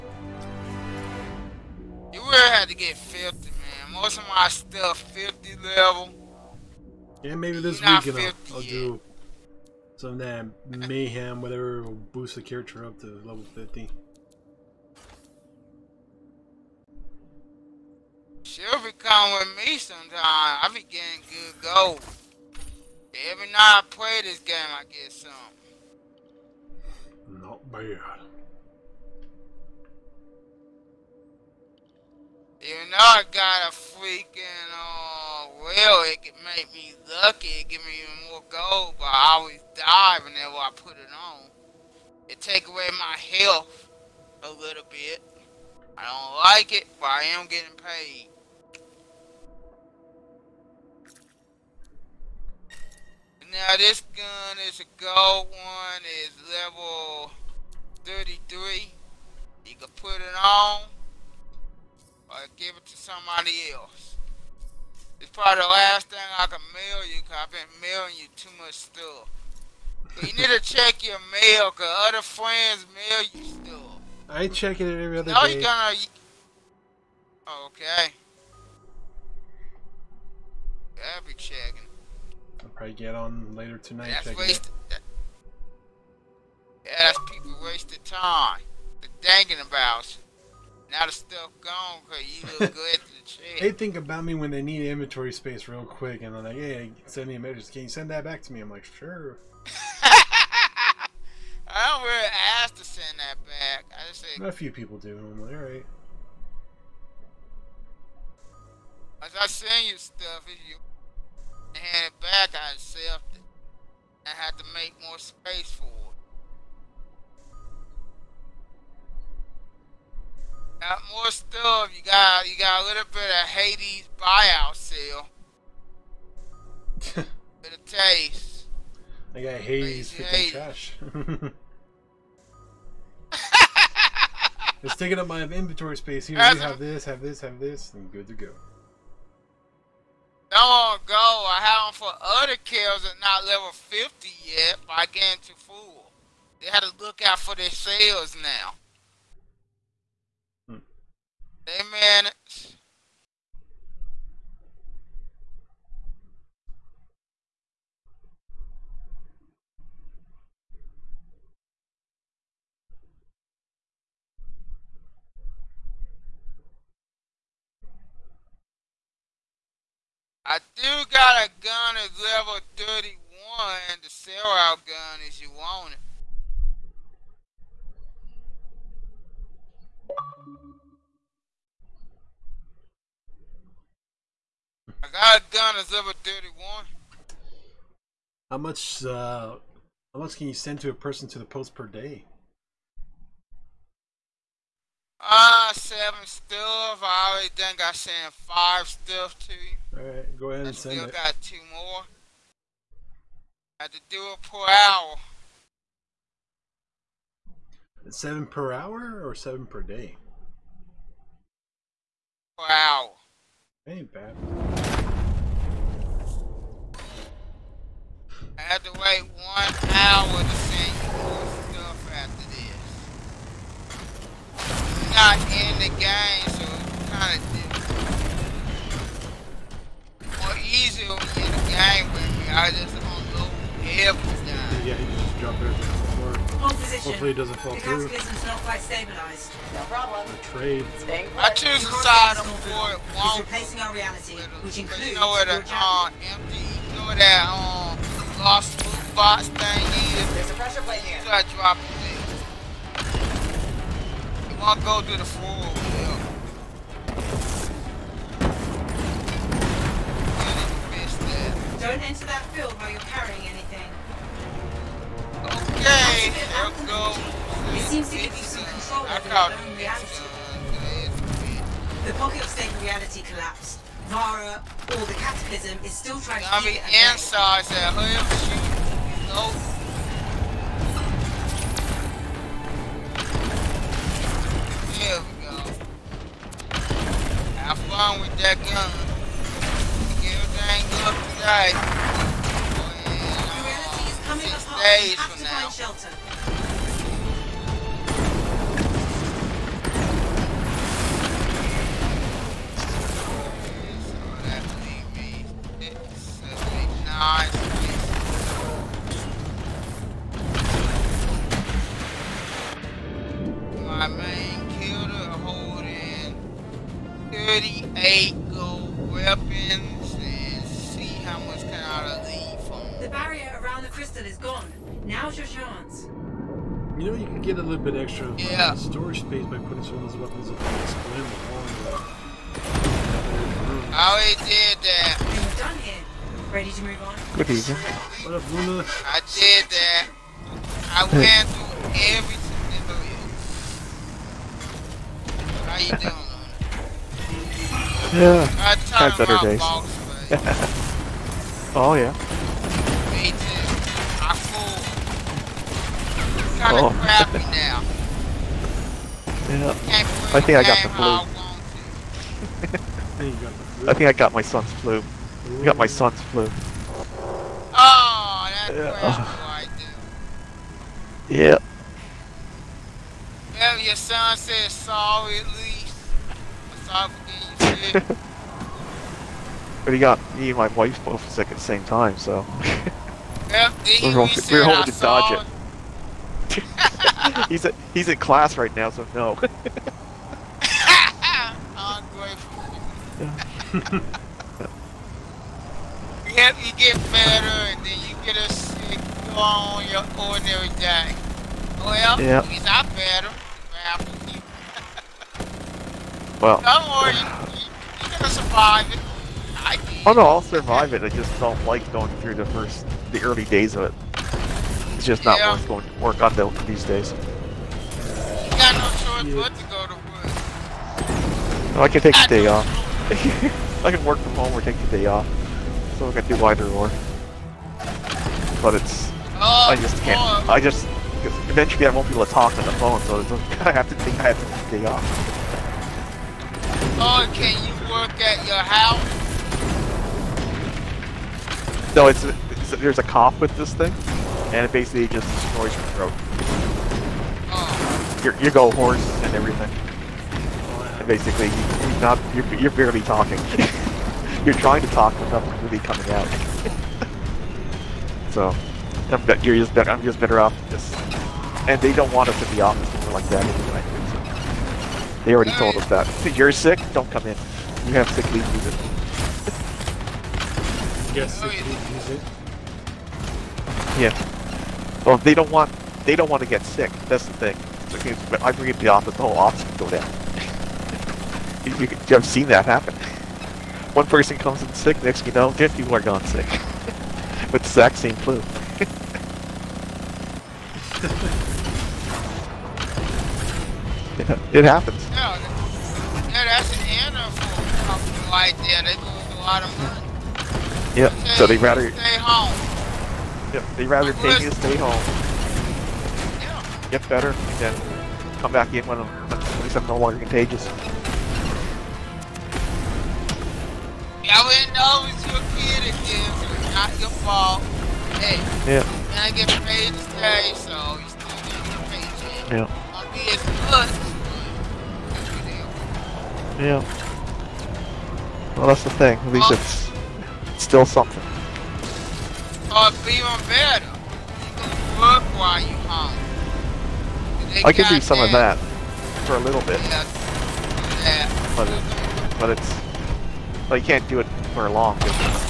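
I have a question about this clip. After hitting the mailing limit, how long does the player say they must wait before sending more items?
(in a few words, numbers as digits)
1 hour.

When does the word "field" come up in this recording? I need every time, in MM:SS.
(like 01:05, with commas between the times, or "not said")
04:22.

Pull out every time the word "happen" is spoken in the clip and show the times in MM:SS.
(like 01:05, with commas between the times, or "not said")
08:02, 08:14.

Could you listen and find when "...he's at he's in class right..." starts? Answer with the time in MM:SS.
06:27.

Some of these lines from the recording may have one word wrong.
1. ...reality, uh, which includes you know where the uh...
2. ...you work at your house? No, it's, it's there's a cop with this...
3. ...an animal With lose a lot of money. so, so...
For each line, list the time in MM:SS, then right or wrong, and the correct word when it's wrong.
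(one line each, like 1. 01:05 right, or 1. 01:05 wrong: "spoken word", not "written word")
1. 04:03 right
2. 07:17 right
3. 08:16 wrong: "They", not "With".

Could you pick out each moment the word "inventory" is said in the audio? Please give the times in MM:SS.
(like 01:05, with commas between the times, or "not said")
01:34, 02:15.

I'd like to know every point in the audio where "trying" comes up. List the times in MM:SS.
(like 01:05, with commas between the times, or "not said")
04:36, 07:34.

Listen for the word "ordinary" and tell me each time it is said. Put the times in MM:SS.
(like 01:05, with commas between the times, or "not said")
06:40.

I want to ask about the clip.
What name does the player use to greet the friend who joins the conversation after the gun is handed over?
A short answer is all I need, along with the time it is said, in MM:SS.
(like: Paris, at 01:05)
Luna, at 05:38.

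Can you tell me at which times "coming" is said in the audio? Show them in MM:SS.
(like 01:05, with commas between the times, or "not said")
00:18, 07:35.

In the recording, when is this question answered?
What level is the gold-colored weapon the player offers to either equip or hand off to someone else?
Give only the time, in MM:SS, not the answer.
00:56.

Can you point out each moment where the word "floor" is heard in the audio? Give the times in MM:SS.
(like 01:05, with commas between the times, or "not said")
03:56, 04:15.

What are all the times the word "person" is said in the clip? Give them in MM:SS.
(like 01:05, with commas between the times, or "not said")
03:10, 08:04.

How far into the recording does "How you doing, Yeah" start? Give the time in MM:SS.
05:45.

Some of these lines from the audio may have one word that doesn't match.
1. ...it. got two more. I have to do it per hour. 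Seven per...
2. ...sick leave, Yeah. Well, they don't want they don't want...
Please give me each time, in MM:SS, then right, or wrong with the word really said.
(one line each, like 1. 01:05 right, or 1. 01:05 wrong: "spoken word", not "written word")
1. 03:21 right
2. 07:51 right.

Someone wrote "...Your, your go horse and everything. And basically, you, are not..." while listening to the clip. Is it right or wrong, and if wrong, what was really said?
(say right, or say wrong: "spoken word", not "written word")
right.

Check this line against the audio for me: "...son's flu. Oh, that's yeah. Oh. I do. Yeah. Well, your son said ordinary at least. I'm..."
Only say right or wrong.
wrong.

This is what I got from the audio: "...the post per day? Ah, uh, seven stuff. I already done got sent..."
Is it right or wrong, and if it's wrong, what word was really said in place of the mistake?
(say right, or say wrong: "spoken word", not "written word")
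right.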